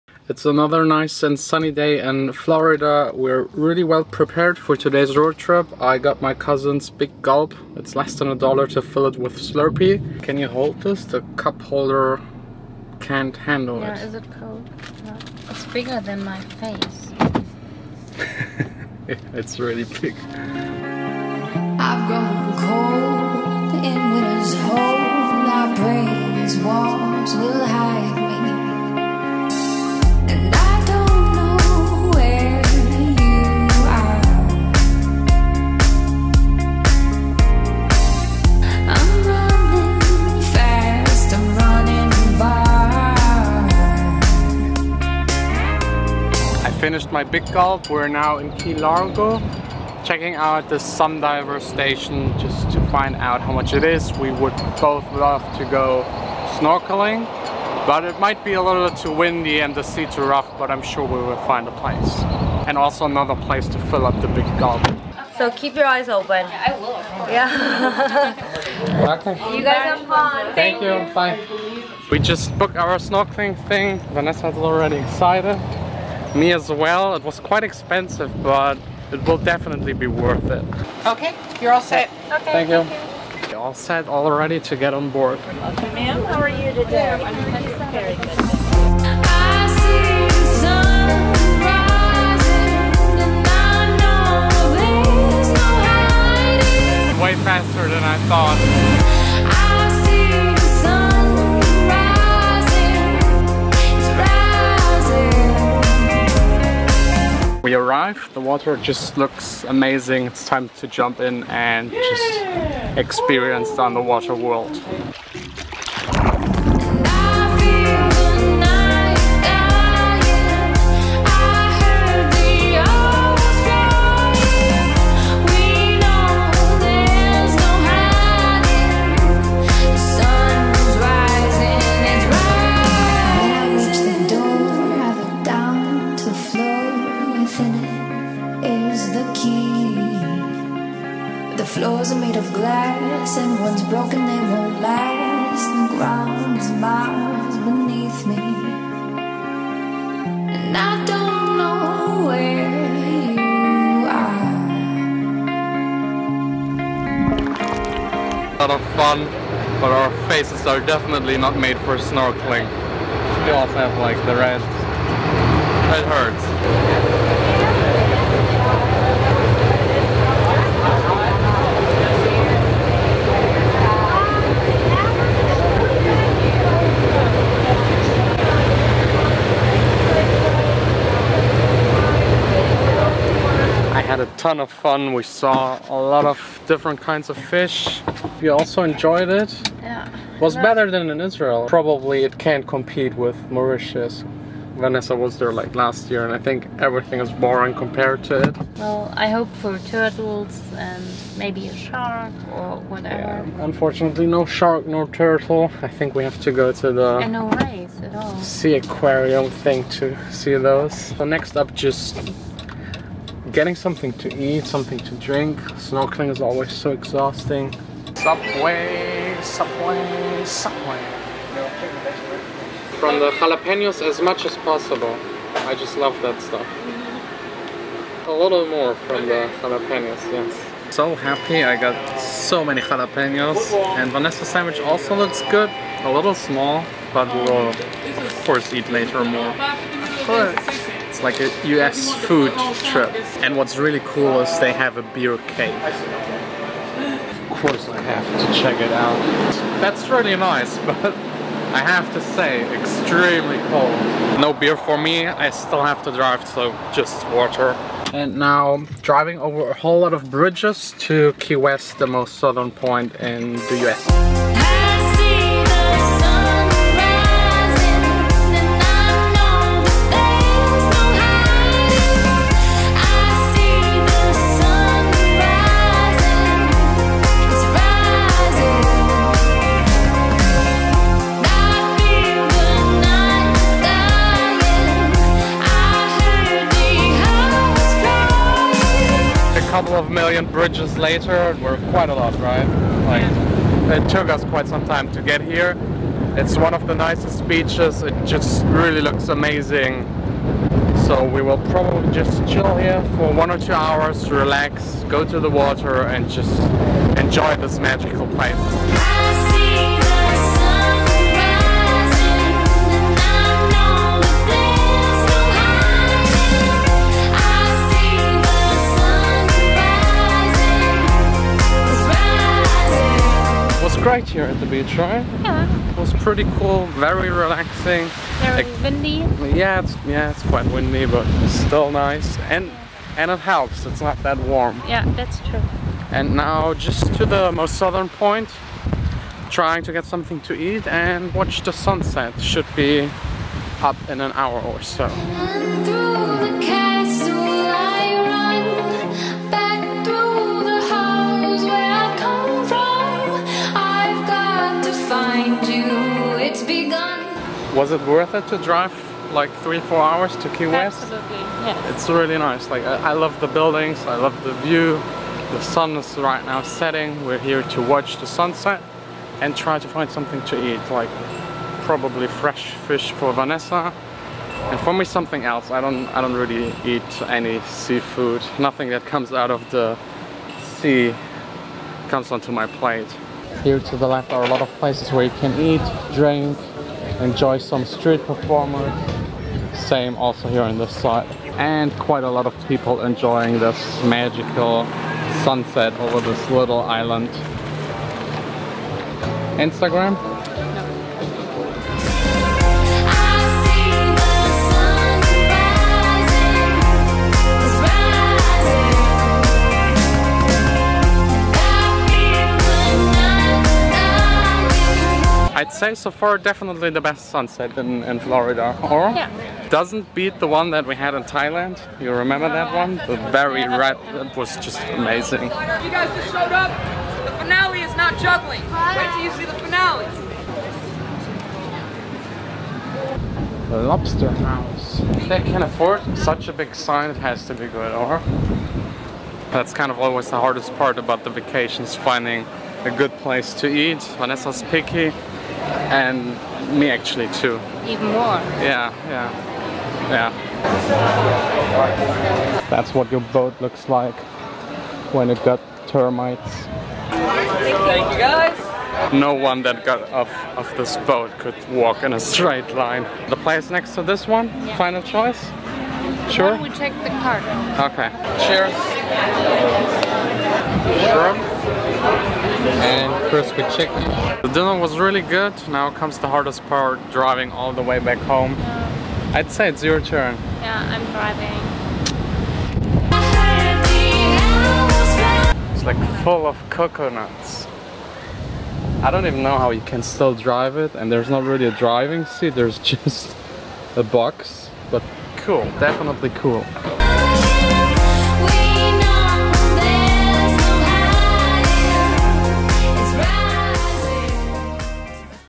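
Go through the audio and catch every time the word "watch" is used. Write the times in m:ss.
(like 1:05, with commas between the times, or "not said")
5:41, 6:07.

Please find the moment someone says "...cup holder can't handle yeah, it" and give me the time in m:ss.
0:11.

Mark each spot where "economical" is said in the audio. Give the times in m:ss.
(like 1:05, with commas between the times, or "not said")
not said.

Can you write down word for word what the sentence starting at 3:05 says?
We saw a lot of different kinds of fish.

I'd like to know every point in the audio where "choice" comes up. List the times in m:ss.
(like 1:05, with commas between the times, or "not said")
7:45.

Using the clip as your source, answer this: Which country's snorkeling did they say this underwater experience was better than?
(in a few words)
Israel.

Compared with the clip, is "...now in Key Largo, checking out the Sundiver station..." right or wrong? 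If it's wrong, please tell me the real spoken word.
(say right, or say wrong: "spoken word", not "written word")
right.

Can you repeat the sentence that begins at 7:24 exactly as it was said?
Vanessa's picky and me actually too.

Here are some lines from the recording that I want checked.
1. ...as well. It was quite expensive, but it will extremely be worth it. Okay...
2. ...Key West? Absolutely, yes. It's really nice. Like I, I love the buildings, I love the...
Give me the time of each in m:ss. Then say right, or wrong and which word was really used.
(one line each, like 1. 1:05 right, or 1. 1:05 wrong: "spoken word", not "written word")
1. 1:16 wrong: "definitely", not "extremely"
2. 6:00 right.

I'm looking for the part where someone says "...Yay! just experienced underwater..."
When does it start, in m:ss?
1:51.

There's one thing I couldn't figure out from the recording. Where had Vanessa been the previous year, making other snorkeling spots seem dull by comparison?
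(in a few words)
Mauritius.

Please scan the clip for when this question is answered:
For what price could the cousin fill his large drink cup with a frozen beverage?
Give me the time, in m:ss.
0:07.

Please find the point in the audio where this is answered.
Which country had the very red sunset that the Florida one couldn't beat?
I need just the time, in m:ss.
7:01.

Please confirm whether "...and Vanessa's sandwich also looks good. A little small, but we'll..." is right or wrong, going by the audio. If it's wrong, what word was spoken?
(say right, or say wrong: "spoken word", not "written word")
right.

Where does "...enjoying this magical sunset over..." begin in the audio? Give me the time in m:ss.
6:33.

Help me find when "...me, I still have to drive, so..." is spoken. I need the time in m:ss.
4:14.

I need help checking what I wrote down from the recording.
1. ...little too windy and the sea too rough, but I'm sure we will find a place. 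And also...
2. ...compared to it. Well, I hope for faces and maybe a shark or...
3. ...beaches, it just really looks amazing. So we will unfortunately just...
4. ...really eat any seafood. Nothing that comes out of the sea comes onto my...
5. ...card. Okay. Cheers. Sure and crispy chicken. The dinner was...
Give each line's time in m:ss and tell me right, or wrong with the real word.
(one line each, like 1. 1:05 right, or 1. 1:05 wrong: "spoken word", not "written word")
1. 0:58 right
2. 3:17 wrong: "turtles", not "faces"
3. 4:57 wrong: "probably", not "unfortunately"
4. 6:16 right
5. 7:47 right.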